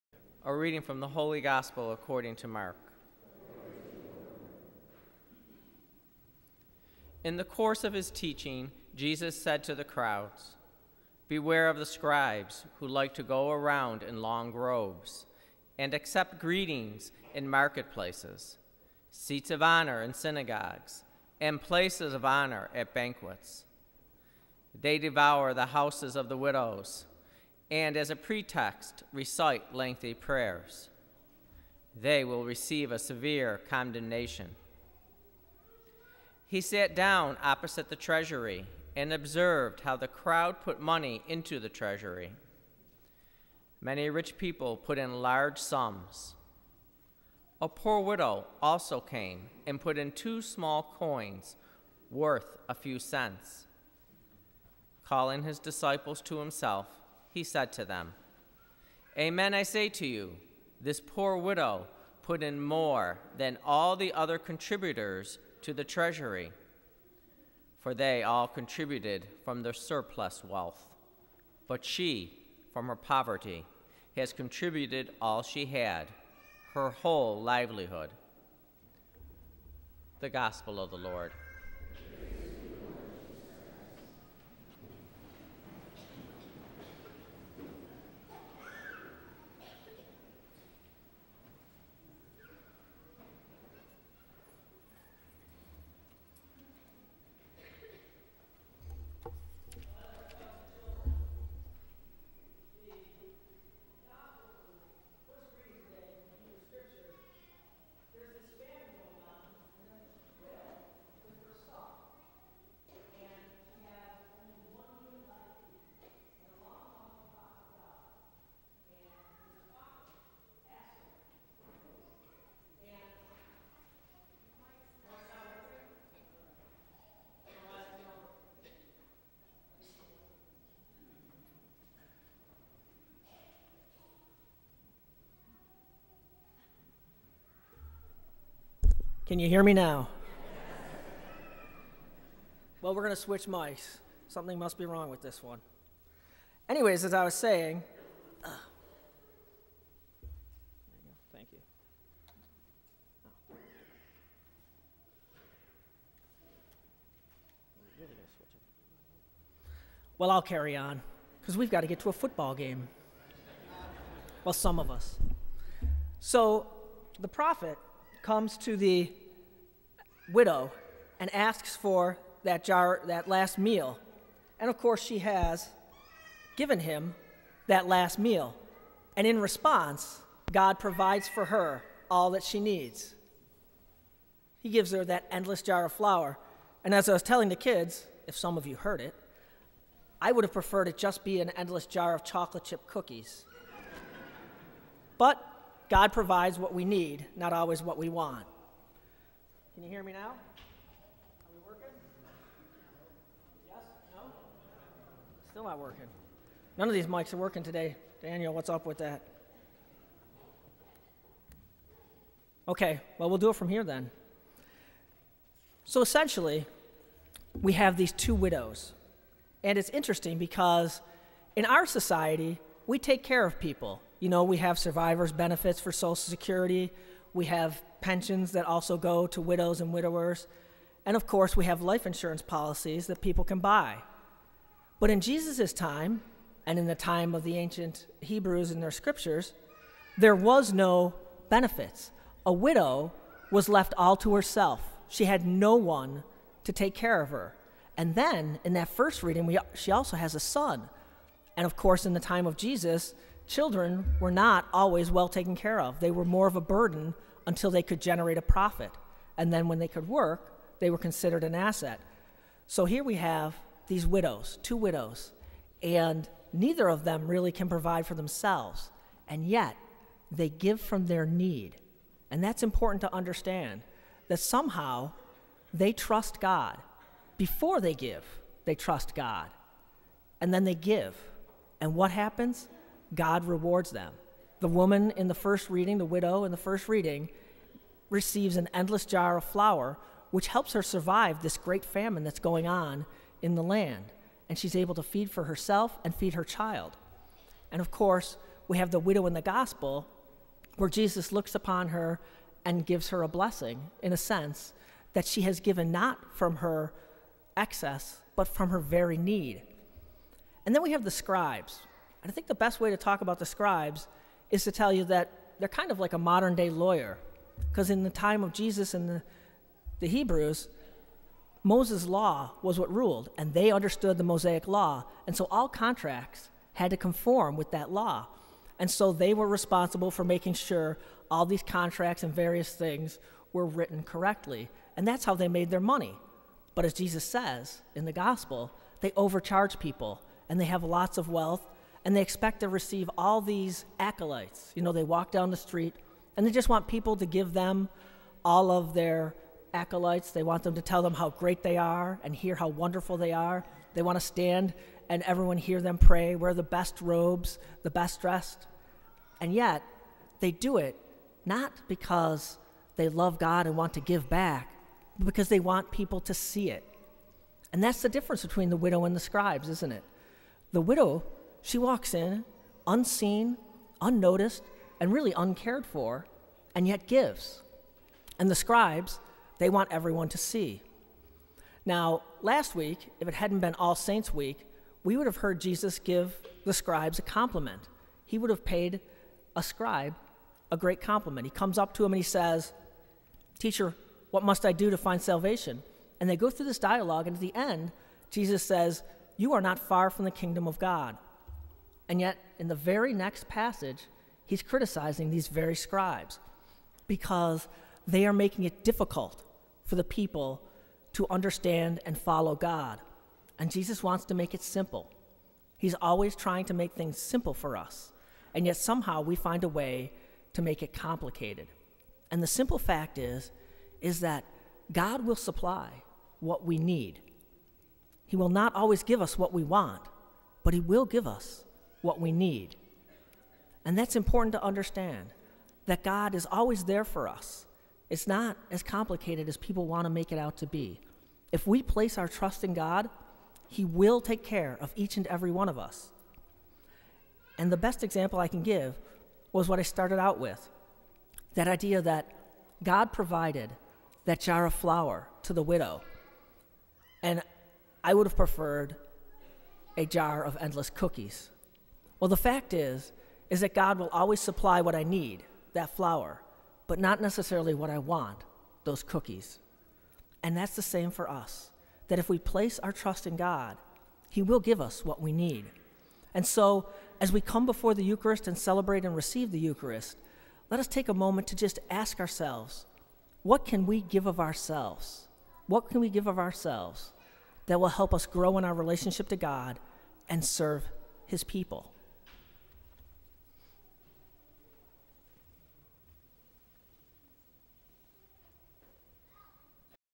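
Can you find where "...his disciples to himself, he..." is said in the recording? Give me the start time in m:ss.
0:55.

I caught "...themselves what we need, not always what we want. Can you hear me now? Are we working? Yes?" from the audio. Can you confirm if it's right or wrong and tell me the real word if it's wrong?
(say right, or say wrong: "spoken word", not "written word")
wrong: "provides", not "themselves".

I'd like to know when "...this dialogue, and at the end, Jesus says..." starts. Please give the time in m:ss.
6:36.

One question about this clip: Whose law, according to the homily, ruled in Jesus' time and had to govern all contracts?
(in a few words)
Moses' law.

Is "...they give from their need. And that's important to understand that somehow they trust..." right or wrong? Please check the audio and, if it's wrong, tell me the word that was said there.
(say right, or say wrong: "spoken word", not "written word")
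right.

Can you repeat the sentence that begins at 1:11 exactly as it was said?
But she, from her poverty, has contributed all she had, her whole livelihood.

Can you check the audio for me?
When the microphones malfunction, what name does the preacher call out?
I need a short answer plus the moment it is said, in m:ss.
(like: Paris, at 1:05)
Daniel, at 3:28.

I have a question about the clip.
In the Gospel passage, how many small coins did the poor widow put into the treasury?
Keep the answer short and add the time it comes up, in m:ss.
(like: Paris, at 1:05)
2, at 0:50.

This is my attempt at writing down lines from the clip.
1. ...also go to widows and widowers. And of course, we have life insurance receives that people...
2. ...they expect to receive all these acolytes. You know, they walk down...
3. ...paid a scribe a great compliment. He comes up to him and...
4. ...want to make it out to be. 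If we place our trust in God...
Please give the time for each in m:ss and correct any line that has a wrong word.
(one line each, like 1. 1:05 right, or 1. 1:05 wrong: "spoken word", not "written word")
1. 3:48 wrong: "policies", not "receives"
2. 5:42 right
3. 6:28 right
4. 7:19 right.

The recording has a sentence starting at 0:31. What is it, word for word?
They will receive a severe condemnation.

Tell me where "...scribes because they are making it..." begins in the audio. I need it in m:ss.
6:45.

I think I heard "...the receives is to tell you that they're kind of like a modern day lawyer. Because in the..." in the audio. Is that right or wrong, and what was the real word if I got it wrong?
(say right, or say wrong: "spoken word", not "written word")
wrong: "scribes", not "receives".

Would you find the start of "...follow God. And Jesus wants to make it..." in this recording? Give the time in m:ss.
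6:52.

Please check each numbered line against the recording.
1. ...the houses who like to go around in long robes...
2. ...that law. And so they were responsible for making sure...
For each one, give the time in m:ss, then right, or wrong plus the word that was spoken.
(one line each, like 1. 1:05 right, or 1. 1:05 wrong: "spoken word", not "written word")
1. 0:11 wrong: "scribes", not "houses"
2. 5:27 right.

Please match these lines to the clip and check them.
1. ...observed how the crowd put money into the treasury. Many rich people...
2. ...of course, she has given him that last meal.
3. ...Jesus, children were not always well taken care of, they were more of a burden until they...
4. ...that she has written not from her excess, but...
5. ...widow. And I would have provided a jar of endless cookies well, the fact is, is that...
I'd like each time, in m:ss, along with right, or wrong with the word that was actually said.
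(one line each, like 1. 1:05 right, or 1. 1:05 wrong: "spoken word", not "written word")
1. 0:39 right
2. 2:54 right
3. 4:12 right
4. 5:05 wrong: "given", not "written"
5. 7:35 wrong: "preferred", not "provided".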